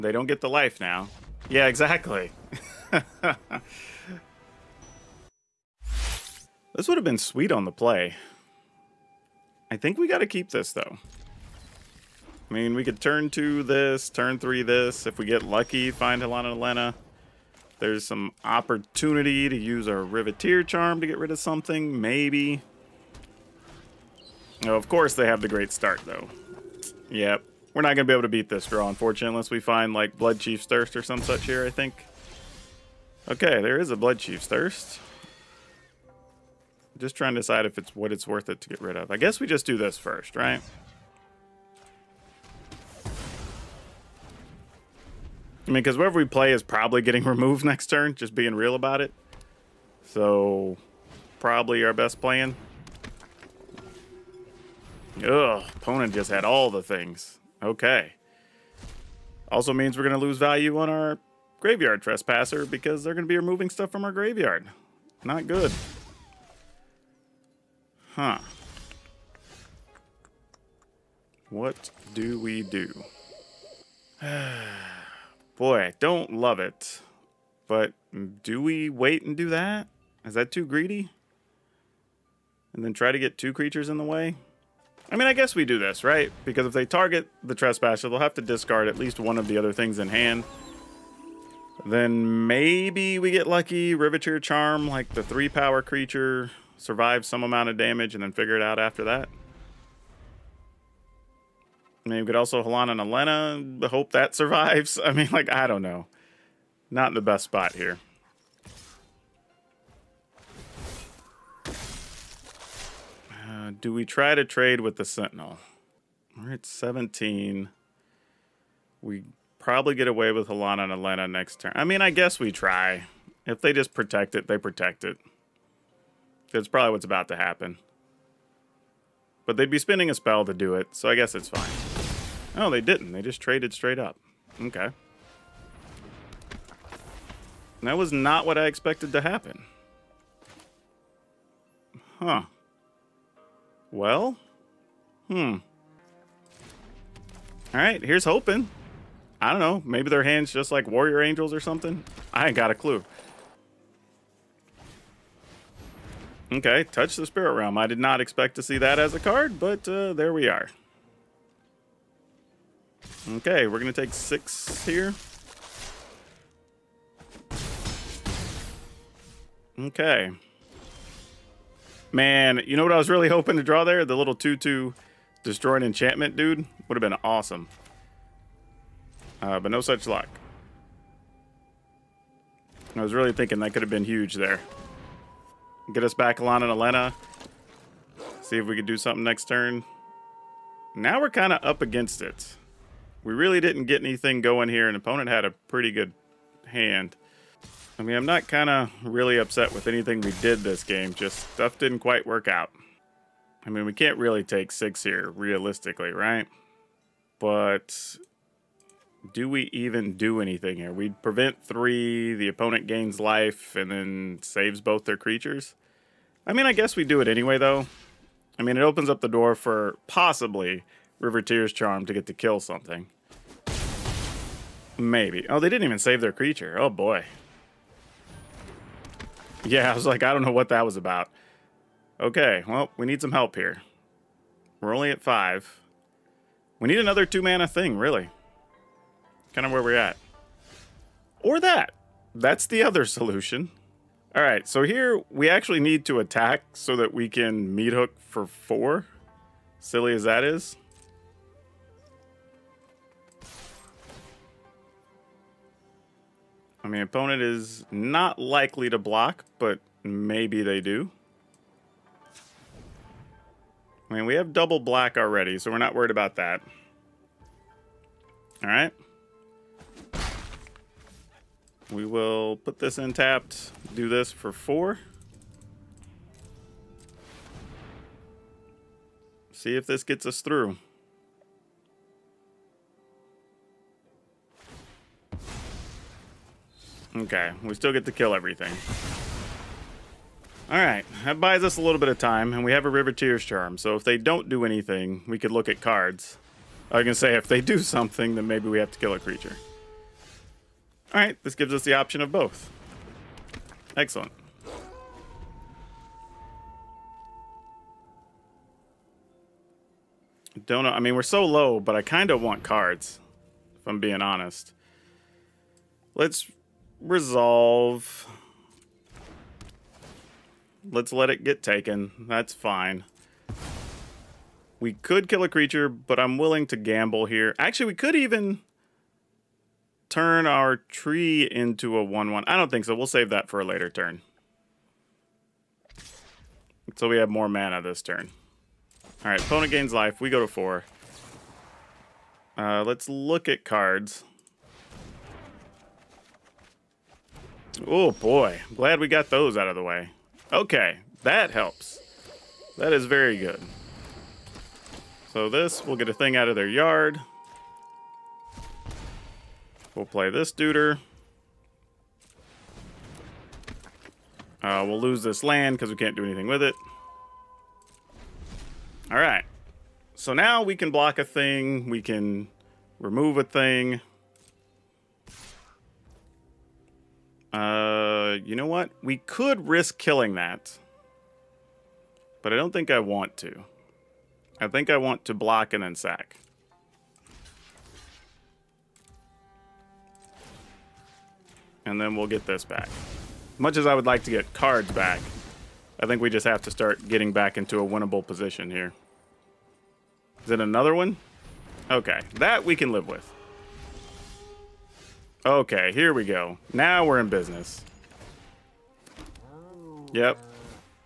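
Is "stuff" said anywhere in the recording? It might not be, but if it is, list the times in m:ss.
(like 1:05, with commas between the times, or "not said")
1:03, 3:21.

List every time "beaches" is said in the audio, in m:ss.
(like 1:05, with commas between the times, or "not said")
not said.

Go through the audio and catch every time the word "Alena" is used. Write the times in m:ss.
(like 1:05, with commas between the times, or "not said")
0:16, 1:43, 2:01, 3:06.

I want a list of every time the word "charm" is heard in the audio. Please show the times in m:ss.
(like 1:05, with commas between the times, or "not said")
0:20, 1:34, 3:41, 4:53.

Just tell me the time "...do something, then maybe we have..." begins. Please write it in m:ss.
4:57.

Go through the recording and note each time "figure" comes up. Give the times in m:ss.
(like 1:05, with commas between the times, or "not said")
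1:38.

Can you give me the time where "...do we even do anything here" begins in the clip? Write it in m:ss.
3:29.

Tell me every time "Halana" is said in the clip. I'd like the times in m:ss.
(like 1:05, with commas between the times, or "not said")
0:16, 1:42, 2:00, 3:06.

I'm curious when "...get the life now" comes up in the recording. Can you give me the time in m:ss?
0:00.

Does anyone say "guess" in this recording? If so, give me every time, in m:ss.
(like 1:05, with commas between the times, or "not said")
0:39, 1:25, 2:02, 2:11, 3:36.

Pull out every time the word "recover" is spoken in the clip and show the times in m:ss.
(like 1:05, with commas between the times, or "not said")
not said.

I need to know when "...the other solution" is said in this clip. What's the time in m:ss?
4:02.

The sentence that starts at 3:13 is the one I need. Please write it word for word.
We really didn't get anything going here.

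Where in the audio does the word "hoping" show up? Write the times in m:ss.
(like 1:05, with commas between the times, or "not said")
2:28, 2:53.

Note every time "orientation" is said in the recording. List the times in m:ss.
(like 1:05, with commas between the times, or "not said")
not said.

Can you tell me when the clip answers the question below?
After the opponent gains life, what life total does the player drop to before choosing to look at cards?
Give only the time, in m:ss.
5:40.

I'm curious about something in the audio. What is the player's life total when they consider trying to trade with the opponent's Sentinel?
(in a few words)
17.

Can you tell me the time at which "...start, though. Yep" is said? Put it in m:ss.
0:25.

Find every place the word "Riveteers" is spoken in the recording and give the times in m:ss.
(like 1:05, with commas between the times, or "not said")
0:19, 1:33, 3:41, 4:52.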